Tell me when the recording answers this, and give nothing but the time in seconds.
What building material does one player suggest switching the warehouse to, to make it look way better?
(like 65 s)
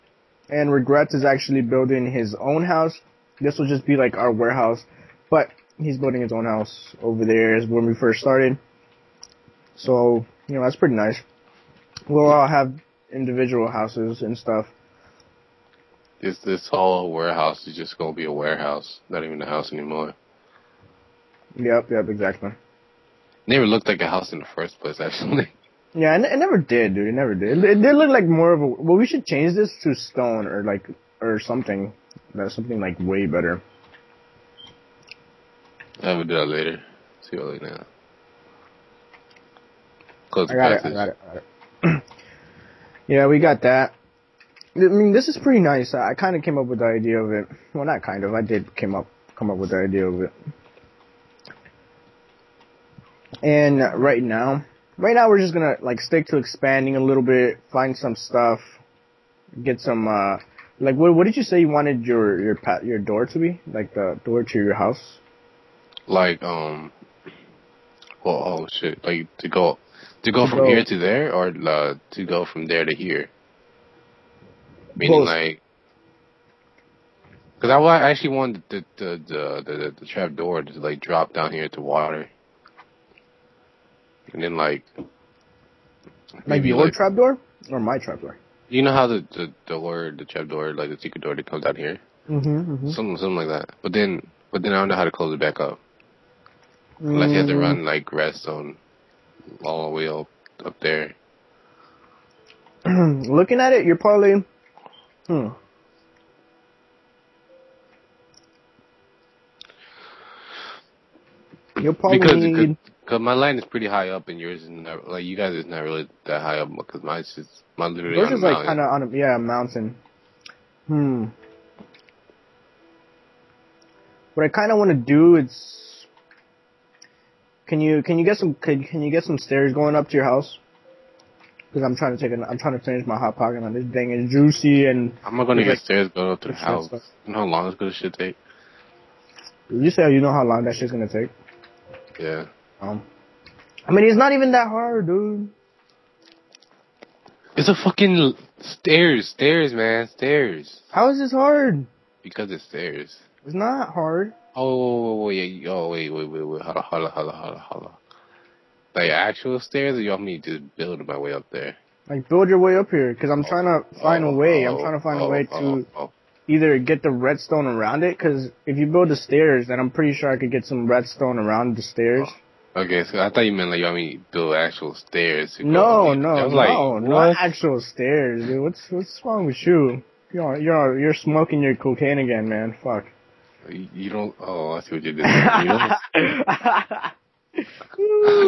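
29 s.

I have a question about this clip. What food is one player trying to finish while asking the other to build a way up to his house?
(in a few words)
hot pocket.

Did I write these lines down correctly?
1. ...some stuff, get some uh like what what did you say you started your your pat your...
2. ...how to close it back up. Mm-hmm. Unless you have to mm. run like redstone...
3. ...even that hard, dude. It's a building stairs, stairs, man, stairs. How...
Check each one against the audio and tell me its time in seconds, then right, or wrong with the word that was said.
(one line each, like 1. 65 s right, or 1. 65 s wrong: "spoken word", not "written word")
1. 57 s wrong: "wanted", not "started"
2. 94 s right
3. 144 s wrong: "fucking", not "building".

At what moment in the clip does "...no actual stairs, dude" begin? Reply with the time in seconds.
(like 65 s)
176 s.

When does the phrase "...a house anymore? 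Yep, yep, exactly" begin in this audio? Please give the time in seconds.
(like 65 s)
19 s.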